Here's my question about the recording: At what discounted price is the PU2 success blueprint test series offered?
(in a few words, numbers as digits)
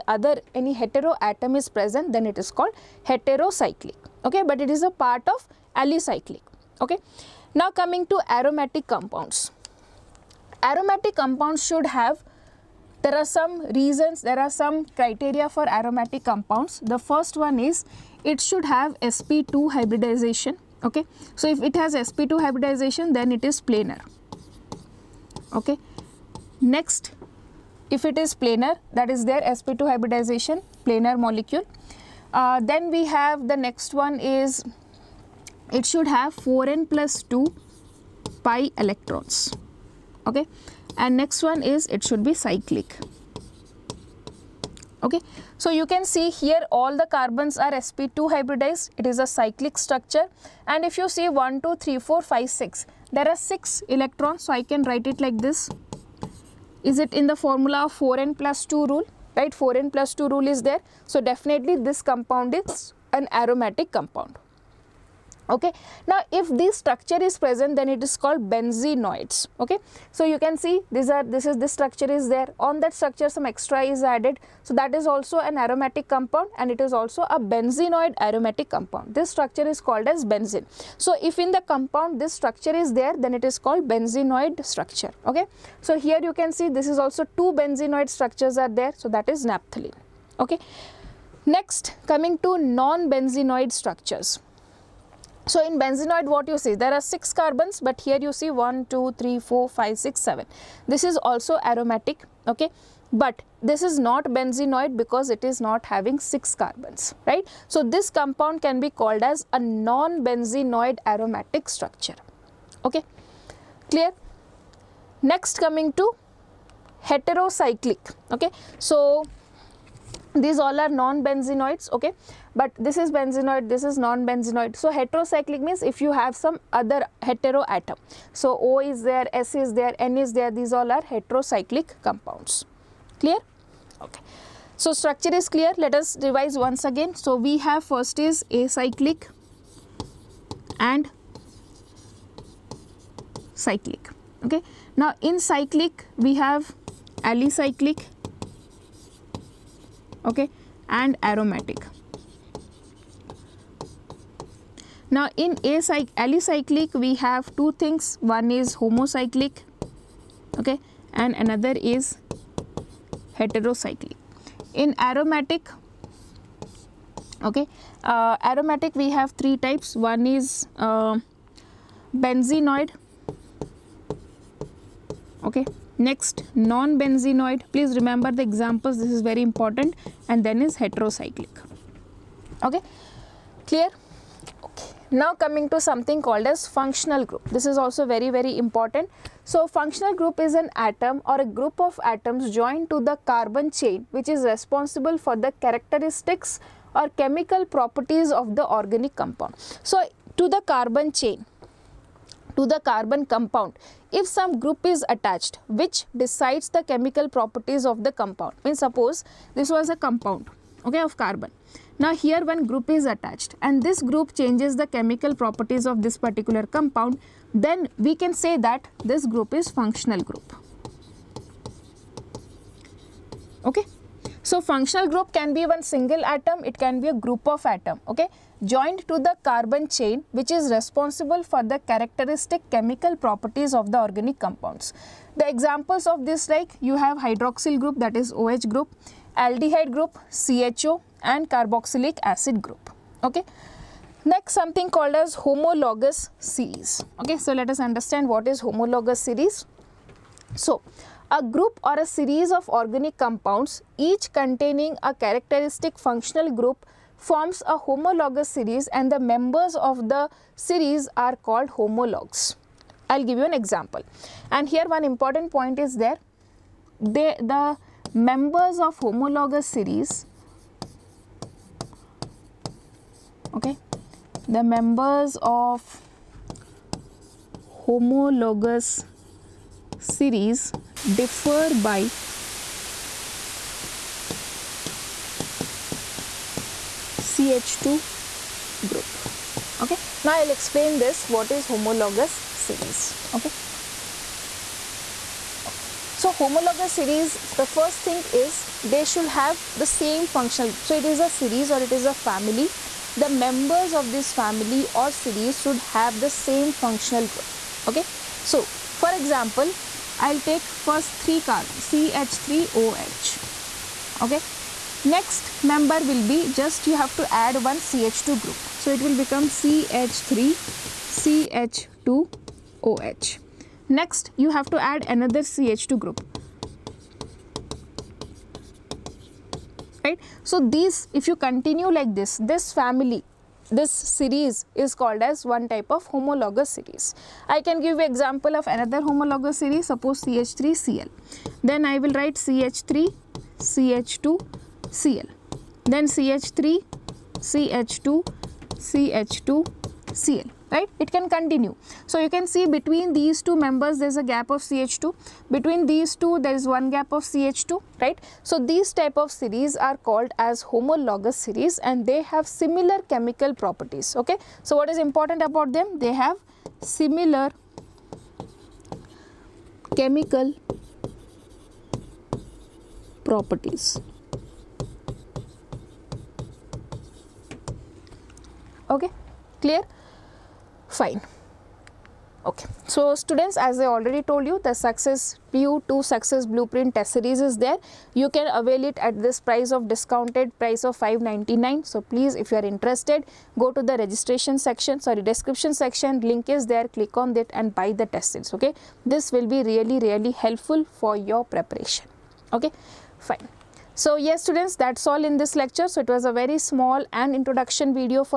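599.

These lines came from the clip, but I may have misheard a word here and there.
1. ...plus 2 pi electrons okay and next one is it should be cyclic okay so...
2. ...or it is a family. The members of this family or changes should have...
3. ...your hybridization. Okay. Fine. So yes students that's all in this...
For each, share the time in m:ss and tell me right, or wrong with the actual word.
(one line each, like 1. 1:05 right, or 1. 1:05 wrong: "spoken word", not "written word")
1. 0:36 right
2. 5:01 wrong: "series", not "changes"
3. 6:41 wrong: "preparation", not "hybridization".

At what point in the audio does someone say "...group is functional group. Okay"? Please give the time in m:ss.
3:39.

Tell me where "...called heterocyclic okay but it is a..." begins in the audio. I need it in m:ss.
0:02.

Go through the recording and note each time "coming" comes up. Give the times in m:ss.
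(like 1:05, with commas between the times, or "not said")
0:07, 1:32, 1:55, 3:05.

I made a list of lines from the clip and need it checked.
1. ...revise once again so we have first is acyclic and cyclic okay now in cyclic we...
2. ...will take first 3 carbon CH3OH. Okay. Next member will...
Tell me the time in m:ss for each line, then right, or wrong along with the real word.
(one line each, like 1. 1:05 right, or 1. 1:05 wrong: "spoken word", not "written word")
1. 2:16 right
2. 5:10 right.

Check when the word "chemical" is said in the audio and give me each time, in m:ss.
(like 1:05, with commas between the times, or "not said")
3:17, 3:26, 3:34, 3:52, 6:03, 6:09.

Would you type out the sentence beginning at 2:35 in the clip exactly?
Now in acyc we have two things one is homocyclic okay and another is heterocyclic.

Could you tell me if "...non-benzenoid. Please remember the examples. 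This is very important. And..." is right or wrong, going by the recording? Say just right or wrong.
right.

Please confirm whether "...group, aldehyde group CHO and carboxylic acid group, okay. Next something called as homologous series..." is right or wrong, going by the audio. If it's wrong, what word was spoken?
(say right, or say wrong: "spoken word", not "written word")
right.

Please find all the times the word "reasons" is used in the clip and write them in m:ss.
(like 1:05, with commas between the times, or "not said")
0:13.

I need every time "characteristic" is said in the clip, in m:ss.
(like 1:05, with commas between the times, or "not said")
3:15, 3:51, 4:15.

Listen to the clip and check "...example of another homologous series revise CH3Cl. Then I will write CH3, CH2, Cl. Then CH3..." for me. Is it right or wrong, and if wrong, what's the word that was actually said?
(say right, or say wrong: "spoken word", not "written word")
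wrong: "suppose", not "revise".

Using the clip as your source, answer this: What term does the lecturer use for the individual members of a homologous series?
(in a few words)
Homologs.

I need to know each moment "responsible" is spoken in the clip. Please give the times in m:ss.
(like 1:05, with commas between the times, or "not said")
3:14, 3:50.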